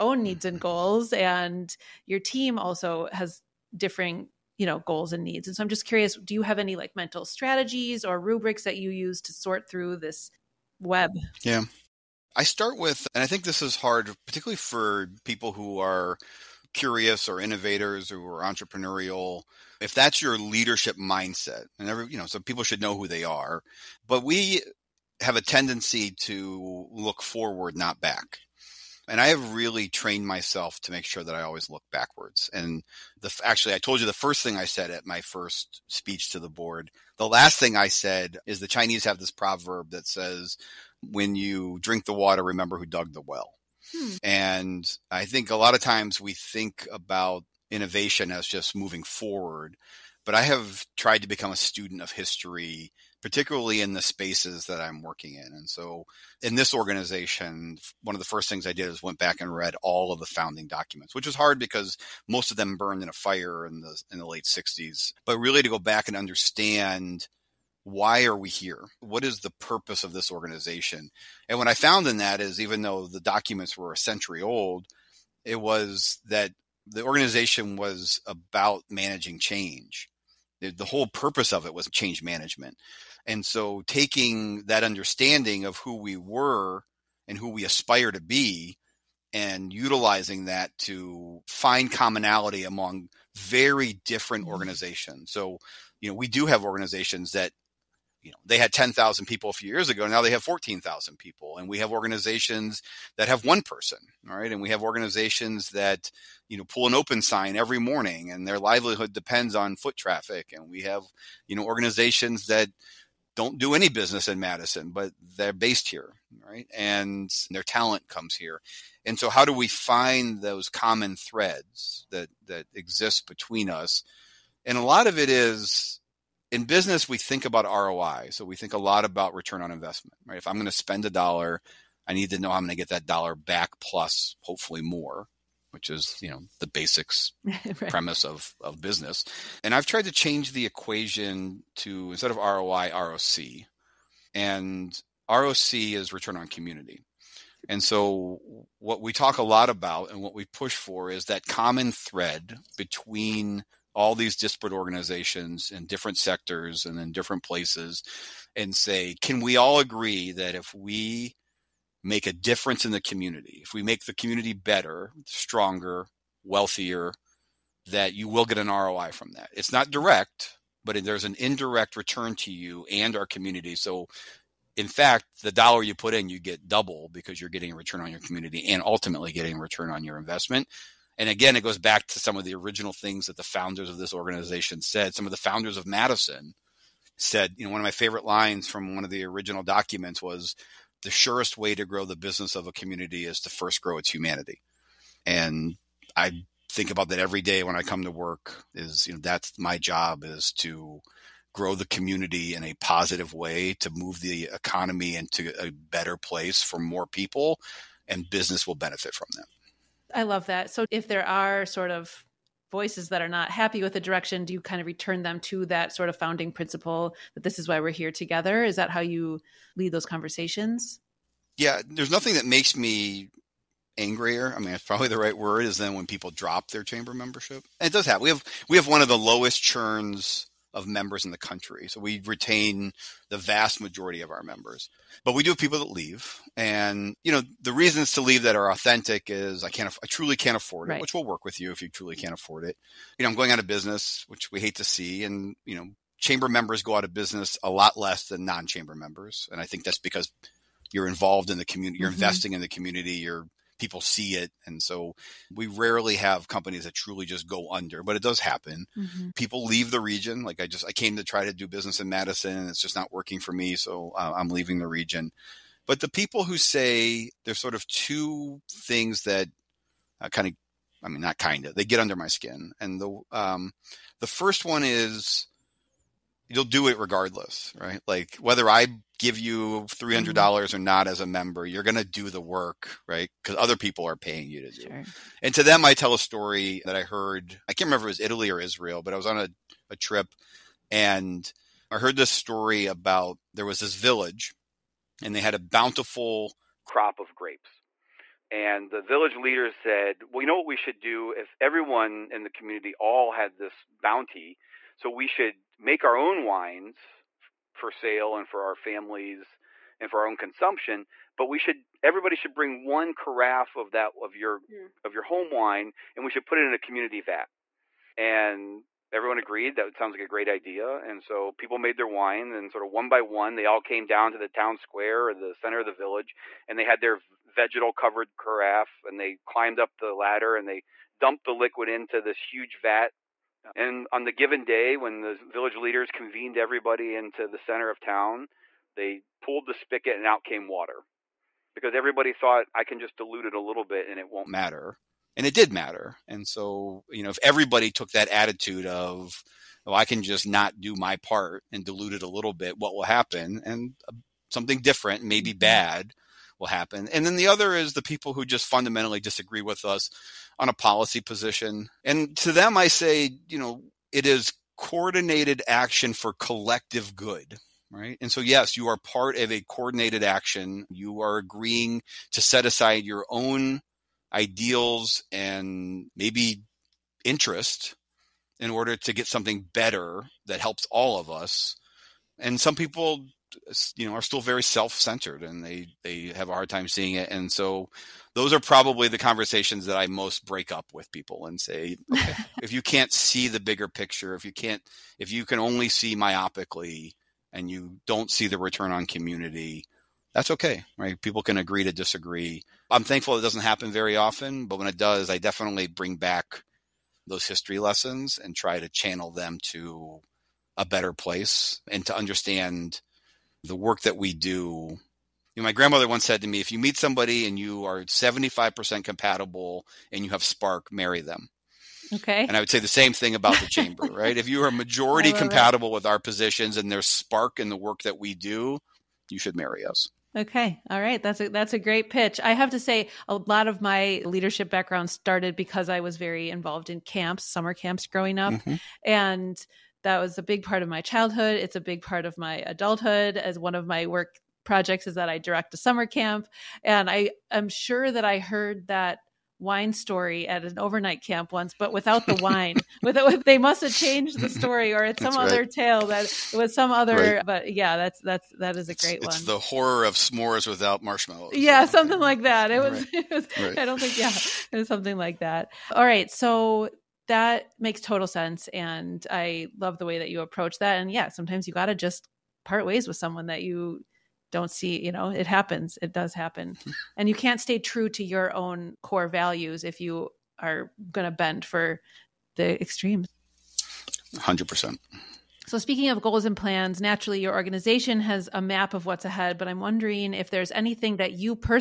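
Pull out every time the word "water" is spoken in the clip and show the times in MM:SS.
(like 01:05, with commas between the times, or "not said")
00:42, 05:40.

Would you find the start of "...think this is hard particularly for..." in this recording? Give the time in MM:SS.
00:13.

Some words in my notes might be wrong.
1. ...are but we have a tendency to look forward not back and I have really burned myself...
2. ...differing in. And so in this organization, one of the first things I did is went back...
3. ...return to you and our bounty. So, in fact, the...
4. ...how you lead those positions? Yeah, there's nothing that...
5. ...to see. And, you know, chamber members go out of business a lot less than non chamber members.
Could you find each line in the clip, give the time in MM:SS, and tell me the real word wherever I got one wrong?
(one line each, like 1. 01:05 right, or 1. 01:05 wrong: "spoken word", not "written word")
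1. 00:23 wrong: "trained", not "burned"
2. 00:55 wrong: "working", not "differing"
3. 02:51 wrong: "community", not "bounty"
4. 03:38 wrong: "conversations", not "positions"
5. 04:04 right.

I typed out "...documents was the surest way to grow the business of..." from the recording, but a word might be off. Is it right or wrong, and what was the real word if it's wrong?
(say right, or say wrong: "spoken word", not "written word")
right.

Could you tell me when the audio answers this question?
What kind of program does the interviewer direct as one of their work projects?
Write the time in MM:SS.
07:25.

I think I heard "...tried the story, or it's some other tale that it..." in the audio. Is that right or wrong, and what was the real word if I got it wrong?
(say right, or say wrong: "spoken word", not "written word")
wrong: "changed", not "tried".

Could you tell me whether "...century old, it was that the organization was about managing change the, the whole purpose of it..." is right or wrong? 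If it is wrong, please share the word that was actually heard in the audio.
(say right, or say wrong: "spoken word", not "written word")
right.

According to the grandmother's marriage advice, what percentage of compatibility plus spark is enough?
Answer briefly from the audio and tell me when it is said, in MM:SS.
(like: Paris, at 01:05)
75%, at 06:58.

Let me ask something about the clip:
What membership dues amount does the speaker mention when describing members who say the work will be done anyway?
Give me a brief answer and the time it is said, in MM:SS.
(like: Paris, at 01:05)
300 dollars, at 04:39.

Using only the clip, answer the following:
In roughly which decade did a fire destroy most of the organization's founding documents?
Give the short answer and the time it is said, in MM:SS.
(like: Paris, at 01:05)
late 60s, at 01:04.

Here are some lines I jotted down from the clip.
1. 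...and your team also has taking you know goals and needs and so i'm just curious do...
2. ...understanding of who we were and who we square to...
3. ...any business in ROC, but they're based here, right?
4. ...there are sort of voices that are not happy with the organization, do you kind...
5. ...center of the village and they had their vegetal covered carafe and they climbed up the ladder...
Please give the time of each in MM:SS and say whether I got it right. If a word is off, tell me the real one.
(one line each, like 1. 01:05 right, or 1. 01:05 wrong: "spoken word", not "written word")
1. 00:01 wrong: "differing", not "taking"
2. 01:24 wrong: "aspire", not "square"
3. 01:53 wrong: "Madison", not "ROC"
4. 03:31 wrong: "direction", not "organization"
5. 05:25 right.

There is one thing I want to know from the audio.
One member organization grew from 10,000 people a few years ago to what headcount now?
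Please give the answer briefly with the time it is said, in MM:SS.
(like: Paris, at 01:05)
14,000, at 01:40.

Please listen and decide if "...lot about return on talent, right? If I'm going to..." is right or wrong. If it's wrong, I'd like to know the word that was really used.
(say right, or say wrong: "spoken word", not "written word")
wrong: "investment", not "talent".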